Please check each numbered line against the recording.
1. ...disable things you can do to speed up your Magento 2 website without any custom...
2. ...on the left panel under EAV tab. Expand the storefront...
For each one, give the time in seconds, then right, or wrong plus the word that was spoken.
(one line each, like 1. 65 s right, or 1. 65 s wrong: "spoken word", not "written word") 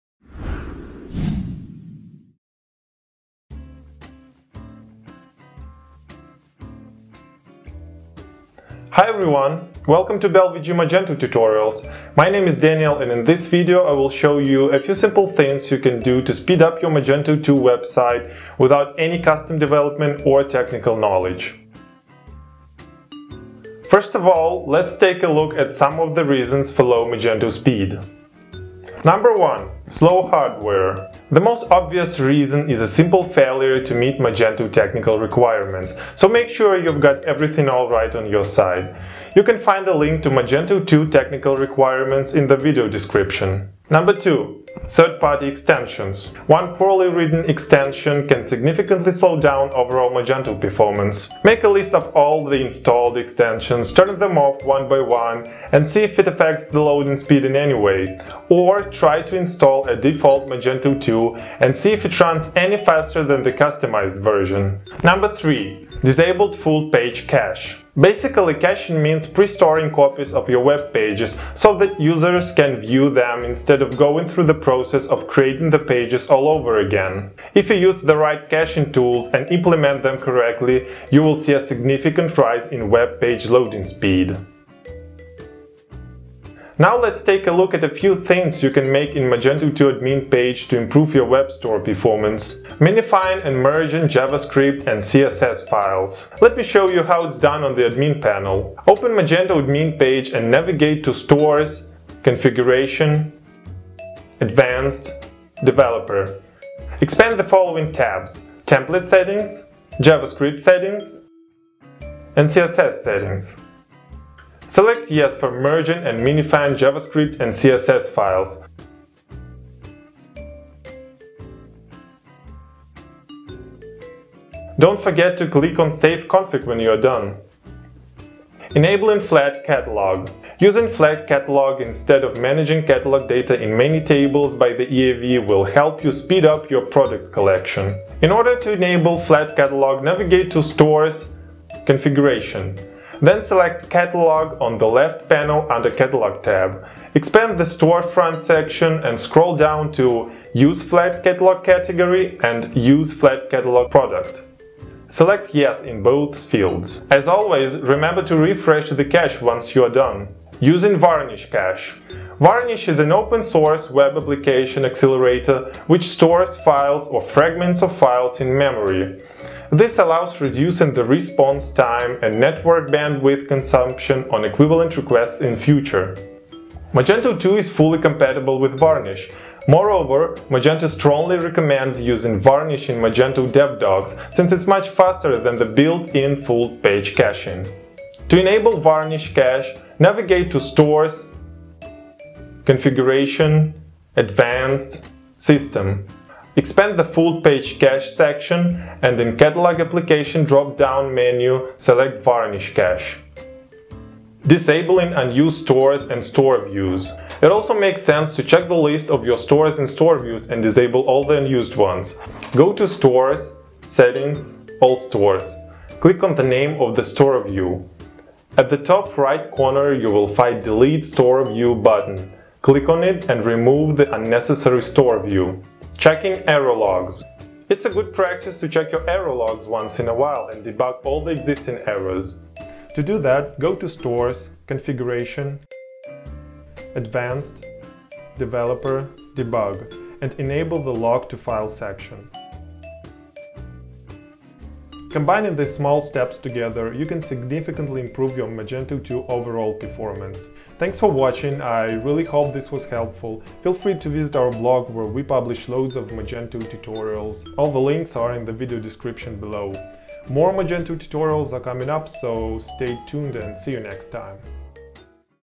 1. 14 s wrong: "simple", not "disable"
2. 144 s wrong: "Catalog", not "EAV".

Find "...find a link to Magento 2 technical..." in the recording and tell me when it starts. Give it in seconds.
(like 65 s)
39 s.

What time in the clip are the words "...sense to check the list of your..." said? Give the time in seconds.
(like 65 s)
208 s.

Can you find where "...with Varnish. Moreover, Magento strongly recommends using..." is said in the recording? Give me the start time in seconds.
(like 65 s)
178 s.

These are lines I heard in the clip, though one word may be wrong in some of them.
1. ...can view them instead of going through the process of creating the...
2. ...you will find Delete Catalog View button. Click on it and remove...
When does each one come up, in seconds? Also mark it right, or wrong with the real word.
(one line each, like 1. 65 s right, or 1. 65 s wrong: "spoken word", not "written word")
1. 72 s right
2. 219 s wrong: "Store", not "Catalog".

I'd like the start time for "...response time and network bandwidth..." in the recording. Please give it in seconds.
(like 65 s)
171 s.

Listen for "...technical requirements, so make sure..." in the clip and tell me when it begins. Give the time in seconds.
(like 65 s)
34 s.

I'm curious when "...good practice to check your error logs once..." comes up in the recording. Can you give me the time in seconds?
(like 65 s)
227 s.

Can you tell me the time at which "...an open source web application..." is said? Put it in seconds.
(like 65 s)
162 s.